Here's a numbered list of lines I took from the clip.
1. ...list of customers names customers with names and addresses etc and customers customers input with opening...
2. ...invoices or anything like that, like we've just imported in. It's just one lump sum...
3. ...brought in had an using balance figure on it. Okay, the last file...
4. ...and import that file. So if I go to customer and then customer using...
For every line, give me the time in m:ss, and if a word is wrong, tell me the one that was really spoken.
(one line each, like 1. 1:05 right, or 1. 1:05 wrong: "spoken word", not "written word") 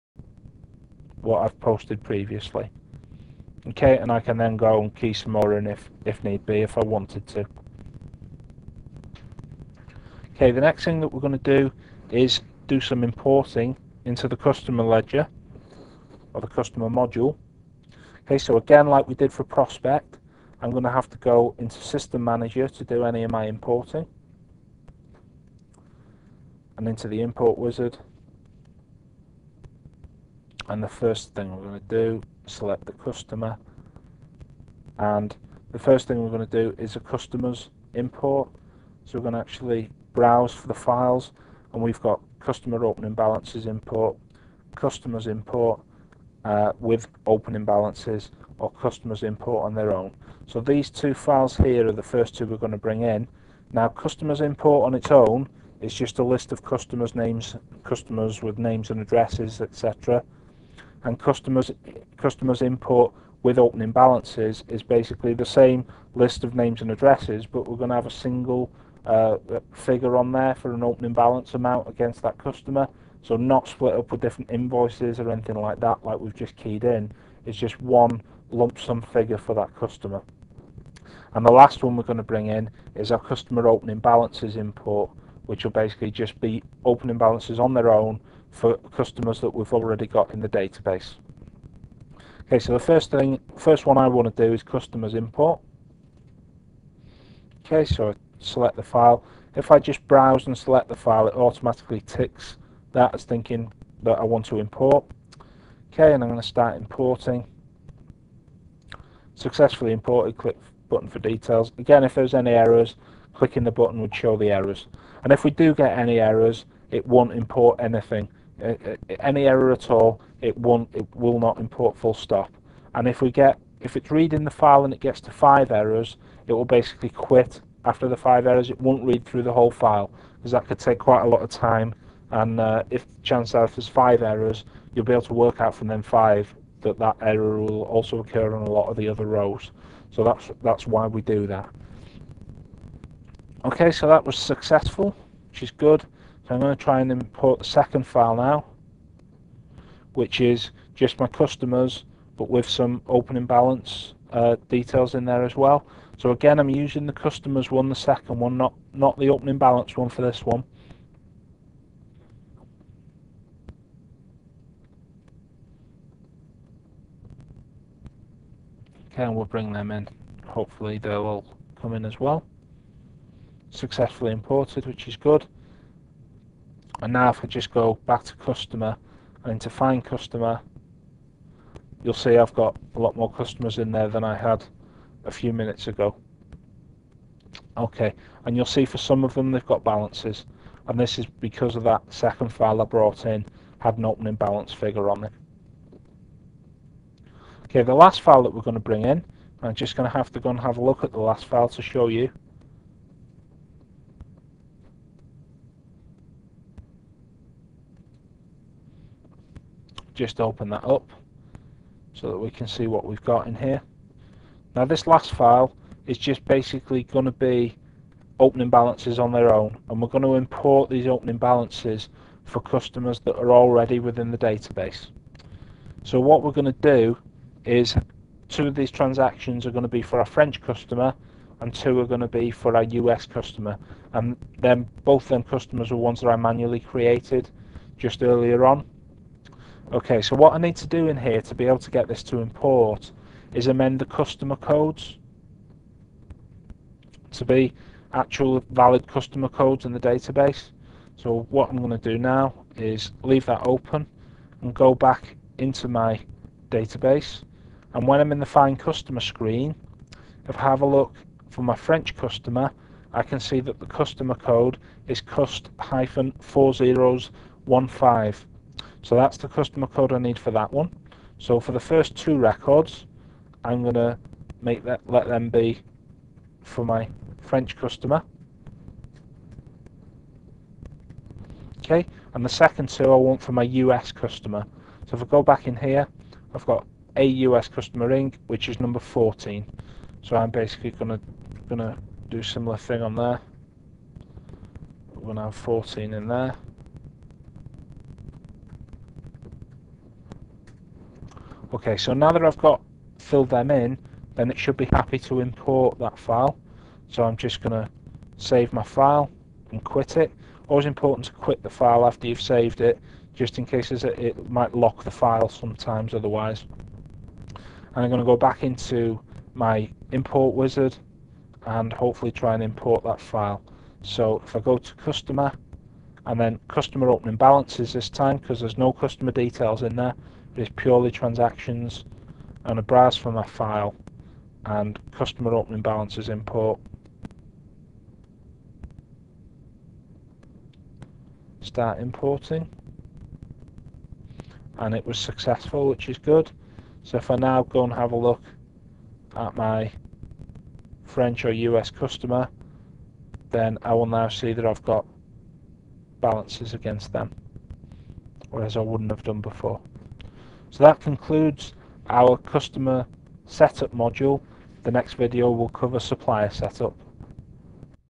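1. 0:56 right
2. 1:14 wrong: "keyed", not "imported"
3. 3:12 wrong: "opening", not "using"
4. 5:22 wrong: "opening", not "using".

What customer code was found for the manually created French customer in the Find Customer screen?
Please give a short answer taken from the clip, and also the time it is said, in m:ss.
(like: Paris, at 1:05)
cust-4015, at 4:25.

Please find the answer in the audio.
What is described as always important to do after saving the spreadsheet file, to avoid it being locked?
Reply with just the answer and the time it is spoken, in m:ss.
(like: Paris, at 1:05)
Quit the file, at 5:11.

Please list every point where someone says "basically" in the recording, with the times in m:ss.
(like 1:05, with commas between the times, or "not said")
1:04, 1:25, 2:06, 3:36, 4:50.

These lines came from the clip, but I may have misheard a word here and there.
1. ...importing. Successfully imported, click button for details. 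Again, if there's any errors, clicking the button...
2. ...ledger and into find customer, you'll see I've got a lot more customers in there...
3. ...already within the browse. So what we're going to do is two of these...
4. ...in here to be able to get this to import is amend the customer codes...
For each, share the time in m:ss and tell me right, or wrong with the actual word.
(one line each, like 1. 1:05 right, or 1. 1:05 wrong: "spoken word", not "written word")
1. 1:46 right
2. 2:58 wrong: "customer", not "ledger"
3. 3:43 wrong: "database", not "browse"
4. 4:01 right.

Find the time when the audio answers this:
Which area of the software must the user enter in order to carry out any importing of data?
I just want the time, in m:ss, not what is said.
0:21.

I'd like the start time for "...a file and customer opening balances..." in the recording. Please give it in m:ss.
5:33.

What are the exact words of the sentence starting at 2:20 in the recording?
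So that's that's why we do that.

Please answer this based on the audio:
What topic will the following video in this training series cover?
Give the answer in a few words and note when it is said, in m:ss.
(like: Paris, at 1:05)
Supplier setup, at 6:05.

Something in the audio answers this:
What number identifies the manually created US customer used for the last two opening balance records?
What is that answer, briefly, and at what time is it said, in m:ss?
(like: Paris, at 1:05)
14, at 4:48.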